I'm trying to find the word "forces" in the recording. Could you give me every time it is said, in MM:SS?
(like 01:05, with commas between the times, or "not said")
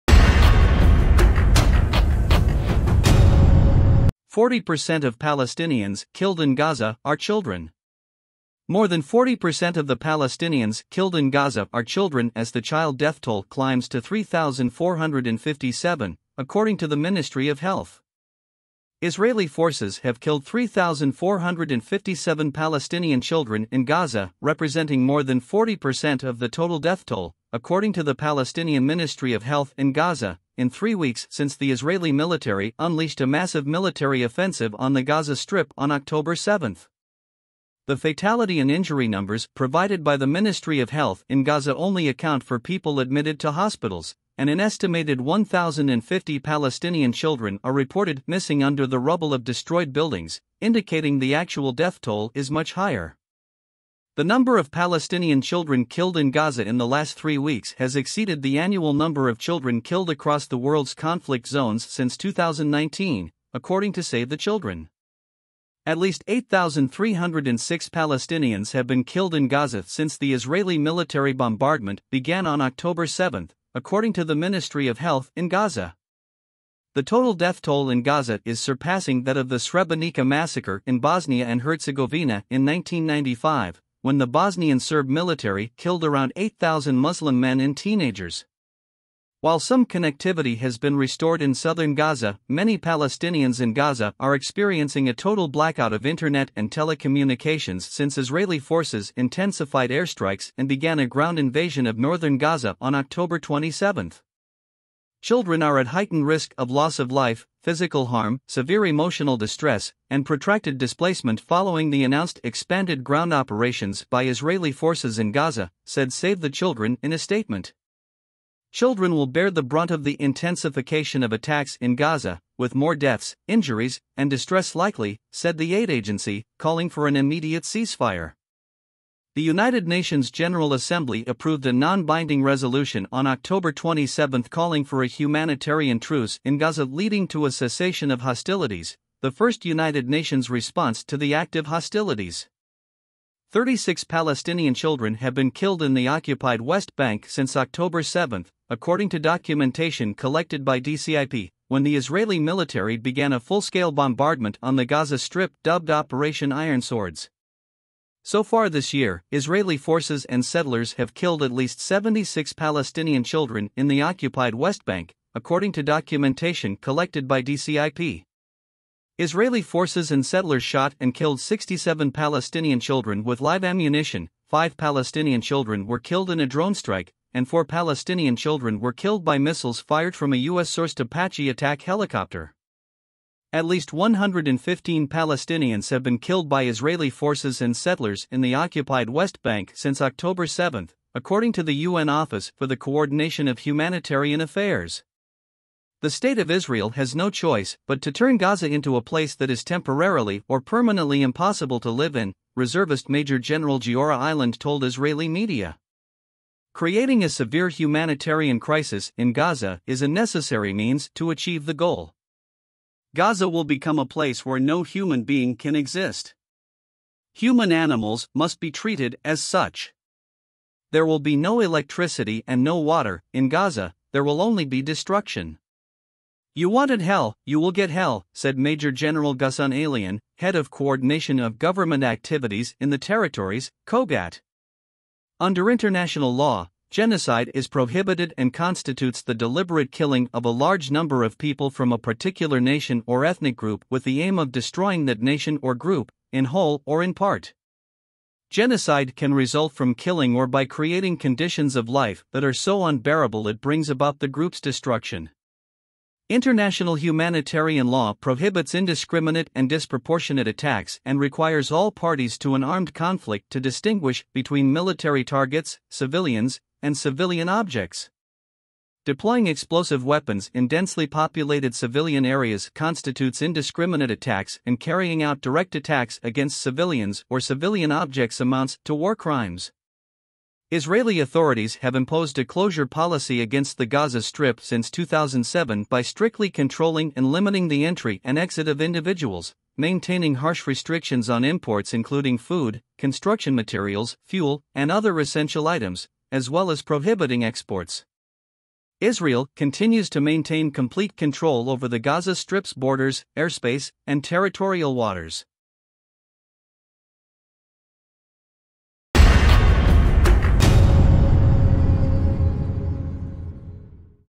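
00:19, 01:38, 01:54, 02:39, 02:49, 03:07.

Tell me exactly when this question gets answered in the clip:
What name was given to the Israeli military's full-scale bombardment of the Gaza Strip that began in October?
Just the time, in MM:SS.
02:35.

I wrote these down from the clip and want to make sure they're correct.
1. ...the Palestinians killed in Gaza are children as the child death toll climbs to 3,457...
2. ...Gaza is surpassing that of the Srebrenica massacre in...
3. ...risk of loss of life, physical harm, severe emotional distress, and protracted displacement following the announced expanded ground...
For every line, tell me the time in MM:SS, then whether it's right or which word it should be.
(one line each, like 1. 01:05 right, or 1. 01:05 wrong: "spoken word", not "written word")
1. 00:09 right
2. 01:18 right
3. 01:46 right.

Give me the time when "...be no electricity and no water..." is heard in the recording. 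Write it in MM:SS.
03:41.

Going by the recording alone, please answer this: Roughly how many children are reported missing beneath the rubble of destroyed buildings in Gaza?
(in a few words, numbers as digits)
1,050.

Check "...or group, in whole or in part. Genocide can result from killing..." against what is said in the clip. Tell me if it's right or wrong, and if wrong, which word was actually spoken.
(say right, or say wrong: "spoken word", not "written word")
right.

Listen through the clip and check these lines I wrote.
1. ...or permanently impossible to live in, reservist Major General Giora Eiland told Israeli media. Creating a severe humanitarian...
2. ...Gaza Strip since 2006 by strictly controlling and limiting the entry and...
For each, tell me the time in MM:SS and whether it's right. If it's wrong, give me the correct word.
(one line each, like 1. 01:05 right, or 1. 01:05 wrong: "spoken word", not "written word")
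1. 03:20 right
2. 04:43 wrong: "2007", not "2006".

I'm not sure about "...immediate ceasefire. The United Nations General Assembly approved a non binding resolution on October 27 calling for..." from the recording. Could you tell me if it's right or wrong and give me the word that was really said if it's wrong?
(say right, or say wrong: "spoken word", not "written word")
right.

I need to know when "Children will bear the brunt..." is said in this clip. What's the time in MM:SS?
01:58.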